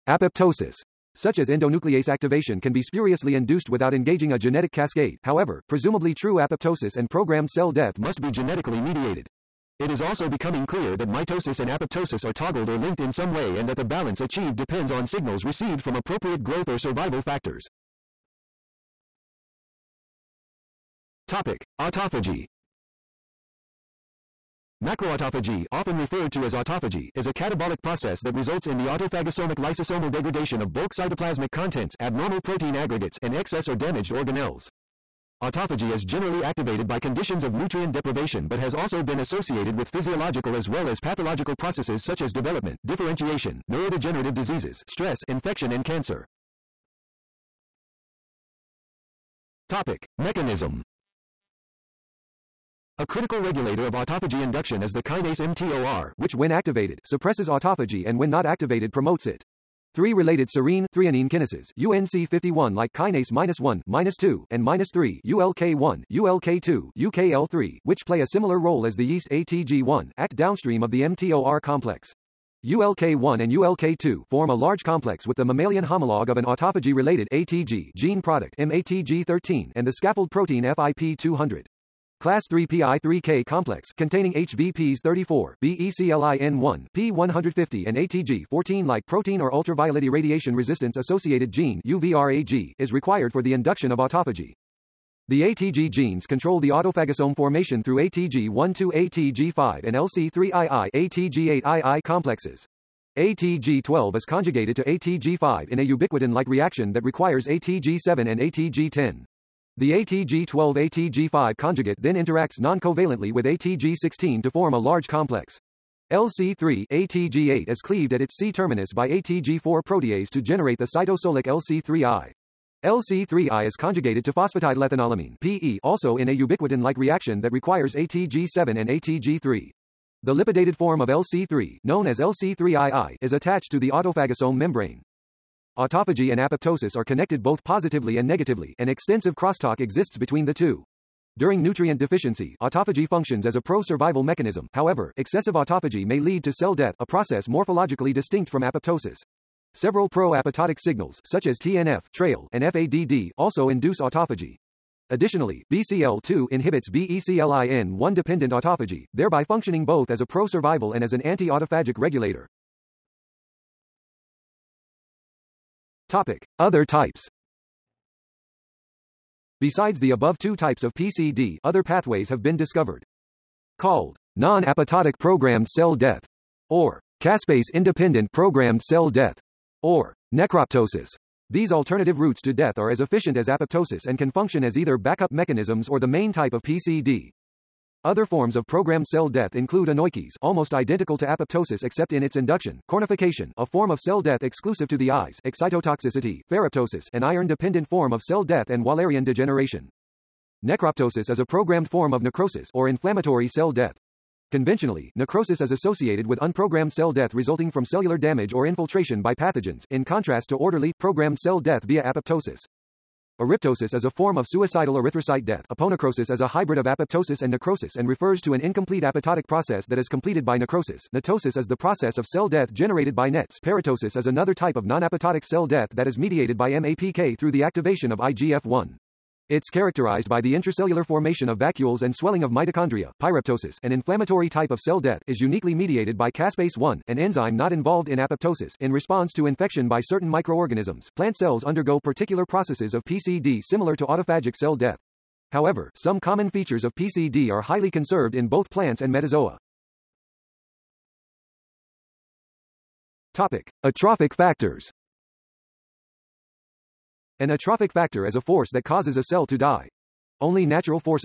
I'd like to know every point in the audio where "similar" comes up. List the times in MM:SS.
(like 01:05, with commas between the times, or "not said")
01:08, 04:03.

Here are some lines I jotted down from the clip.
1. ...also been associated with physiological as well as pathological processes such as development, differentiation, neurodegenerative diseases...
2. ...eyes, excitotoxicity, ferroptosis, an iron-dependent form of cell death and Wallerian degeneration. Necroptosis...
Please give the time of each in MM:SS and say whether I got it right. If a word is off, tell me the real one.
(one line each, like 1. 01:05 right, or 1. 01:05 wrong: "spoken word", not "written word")
1. 00:38 right
2. 03:15 right.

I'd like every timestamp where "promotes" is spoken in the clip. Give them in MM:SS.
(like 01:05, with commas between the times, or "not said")
00:58.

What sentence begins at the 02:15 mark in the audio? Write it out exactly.
Autophagy and apoptosis are connected both positively and negatively, and extensive crosstalk exists between the two.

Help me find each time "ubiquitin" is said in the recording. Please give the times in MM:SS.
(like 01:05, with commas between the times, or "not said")
01:45, 02:06.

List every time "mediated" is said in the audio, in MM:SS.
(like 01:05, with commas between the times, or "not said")
00:08, 03:46, 03:55.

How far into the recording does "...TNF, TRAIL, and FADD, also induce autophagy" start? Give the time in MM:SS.
02:31.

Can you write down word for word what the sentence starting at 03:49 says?
It's characterized by the intracellular formation of vacuoles and swelling of mitochondria.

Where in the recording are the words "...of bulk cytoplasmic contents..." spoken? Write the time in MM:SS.
00:30.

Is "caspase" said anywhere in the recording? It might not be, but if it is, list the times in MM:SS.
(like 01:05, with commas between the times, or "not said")
02:57, 03:56.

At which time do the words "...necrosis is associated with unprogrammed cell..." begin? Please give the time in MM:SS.
03:25.